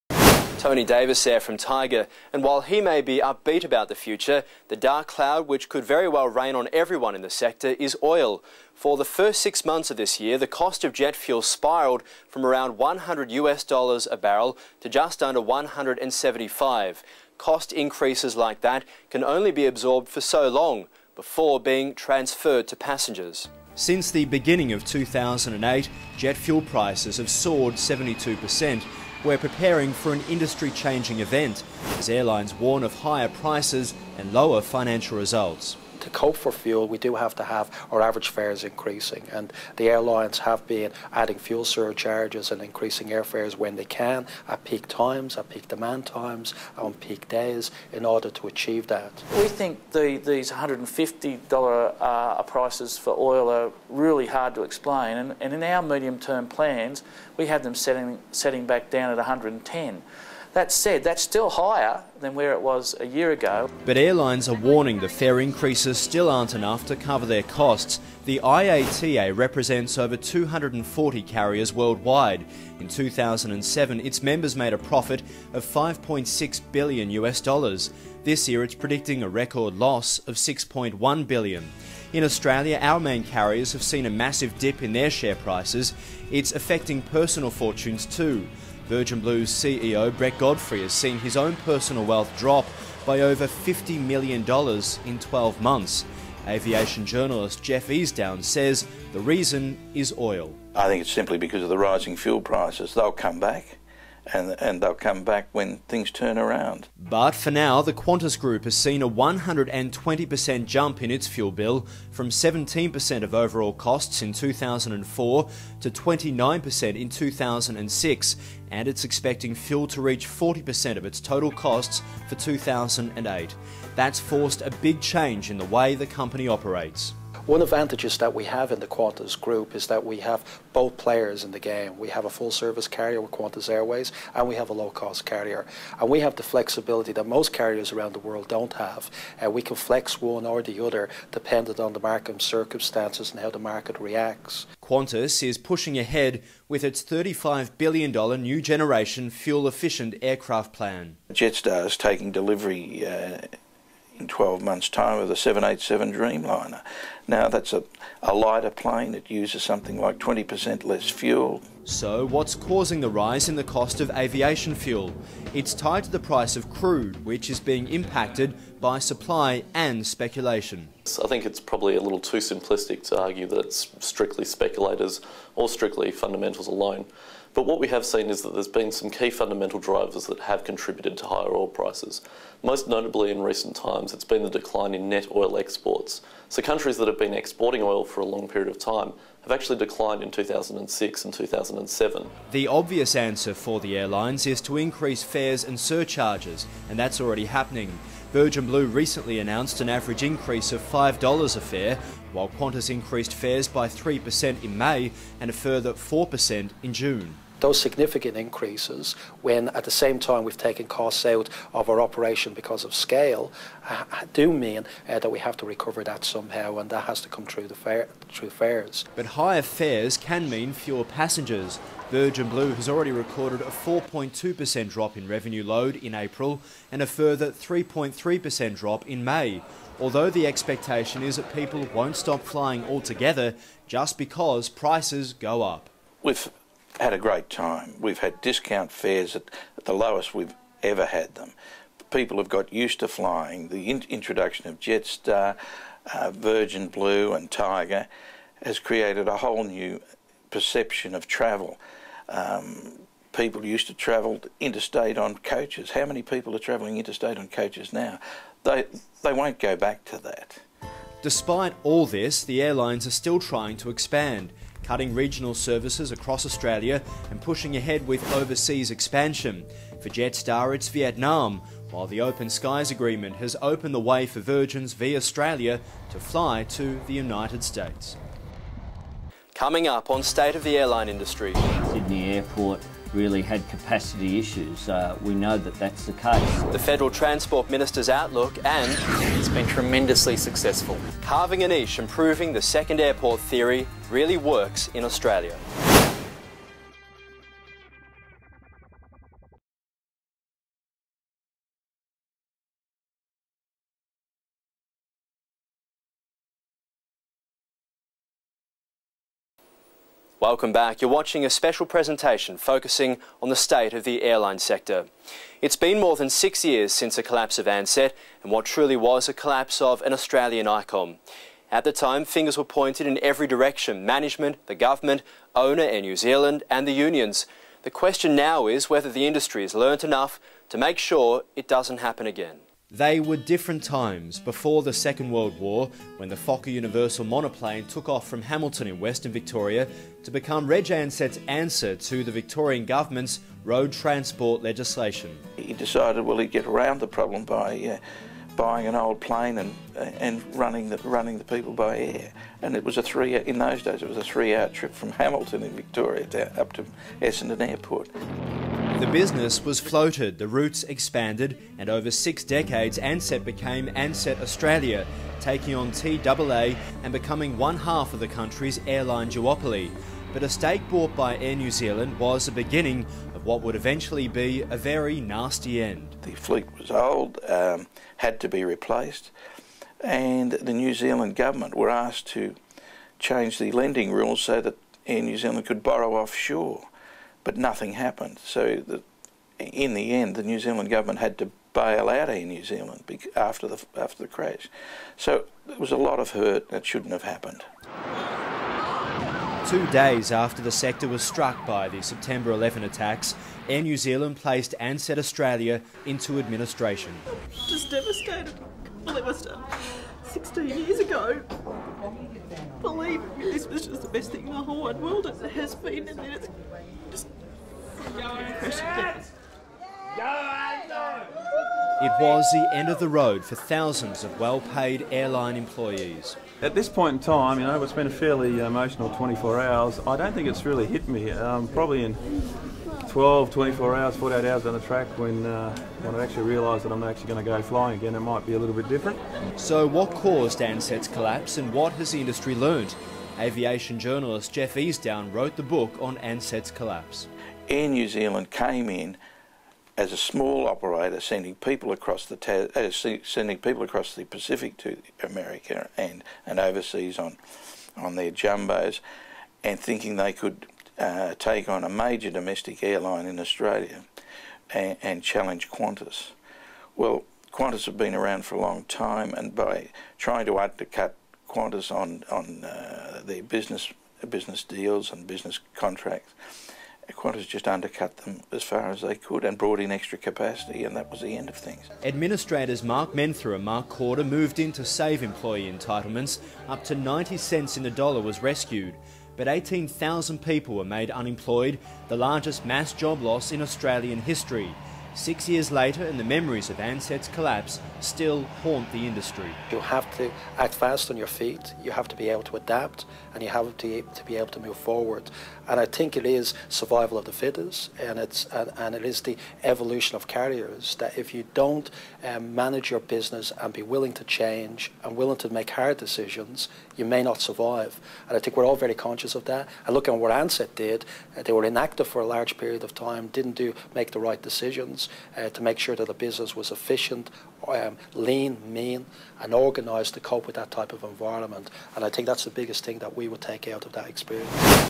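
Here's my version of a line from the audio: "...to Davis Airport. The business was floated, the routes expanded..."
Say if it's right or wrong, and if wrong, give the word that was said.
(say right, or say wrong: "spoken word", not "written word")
wrong: "Essendon", not "Davis".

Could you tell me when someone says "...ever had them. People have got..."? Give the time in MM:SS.
04:00.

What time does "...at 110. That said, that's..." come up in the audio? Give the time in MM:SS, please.
00:59.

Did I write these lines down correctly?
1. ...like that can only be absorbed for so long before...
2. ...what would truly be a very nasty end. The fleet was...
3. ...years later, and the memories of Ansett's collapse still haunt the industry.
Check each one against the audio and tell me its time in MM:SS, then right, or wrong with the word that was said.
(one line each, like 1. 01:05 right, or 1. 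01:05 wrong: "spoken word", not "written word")
1. 00:18 right
2. 06:13 wrong: "eventually", not "truly"
3. 08:15 right.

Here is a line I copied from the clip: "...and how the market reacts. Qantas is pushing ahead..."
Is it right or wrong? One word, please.
right.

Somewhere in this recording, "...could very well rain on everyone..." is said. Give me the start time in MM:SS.
00:05.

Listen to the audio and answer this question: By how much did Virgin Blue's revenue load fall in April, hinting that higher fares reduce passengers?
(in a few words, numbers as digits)
4.2%.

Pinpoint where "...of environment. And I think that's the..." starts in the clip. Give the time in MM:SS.
08:50.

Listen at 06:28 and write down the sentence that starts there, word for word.
So the, in the end, the New Zealand government had to bail out Air New Zealand after the after the crash.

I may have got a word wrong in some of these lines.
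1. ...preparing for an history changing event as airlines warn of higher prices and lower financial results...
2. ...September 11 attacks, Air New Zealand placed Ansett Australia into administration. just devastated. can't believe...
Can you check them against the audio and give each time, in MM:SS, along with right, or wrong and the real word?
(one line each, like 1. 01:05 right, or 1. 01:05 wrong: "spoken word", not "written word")
1. 00:29 wrong: "industry", not "history"
2. 06:42 right.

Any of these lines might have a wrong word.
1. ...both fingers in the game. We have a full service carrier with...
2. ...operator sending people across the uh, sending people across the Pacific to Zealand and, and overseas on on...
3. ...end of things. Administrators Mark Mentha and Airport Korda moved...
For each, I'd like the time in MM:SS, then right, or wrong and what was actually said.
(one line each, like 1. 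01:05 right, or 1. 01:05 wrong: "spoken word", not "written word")
1. 02:10 wrong: "players", not "fingers"
2. 07:30 wrong: "America", not "Zealand"
3. 08:01 wrong: "Mark", not "Airport".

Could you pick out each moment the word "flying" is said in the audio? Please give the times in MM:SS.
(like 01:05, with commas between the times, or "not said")
03:52, 04:03, 07:17.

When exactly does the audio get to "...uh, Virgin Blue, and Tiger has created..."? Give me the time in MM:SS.
04:06.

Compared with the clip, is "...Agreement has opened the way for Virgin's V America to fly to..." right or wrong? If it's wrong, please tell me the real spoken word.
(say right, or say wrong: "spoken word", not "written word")
wrong: "Australia", not "America".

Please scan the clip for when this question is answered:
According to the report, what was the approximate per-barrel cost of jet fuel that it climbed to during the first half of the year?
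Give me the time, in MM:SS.
00:14.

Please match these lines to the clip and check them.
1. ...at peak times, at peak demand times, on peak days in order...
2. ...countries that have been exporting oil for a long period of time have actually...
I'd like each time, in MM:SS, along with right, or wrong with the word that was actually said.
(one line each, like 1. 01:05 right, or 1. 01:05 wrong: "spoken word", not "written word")
1. 00:44 right
2. 03:06 right.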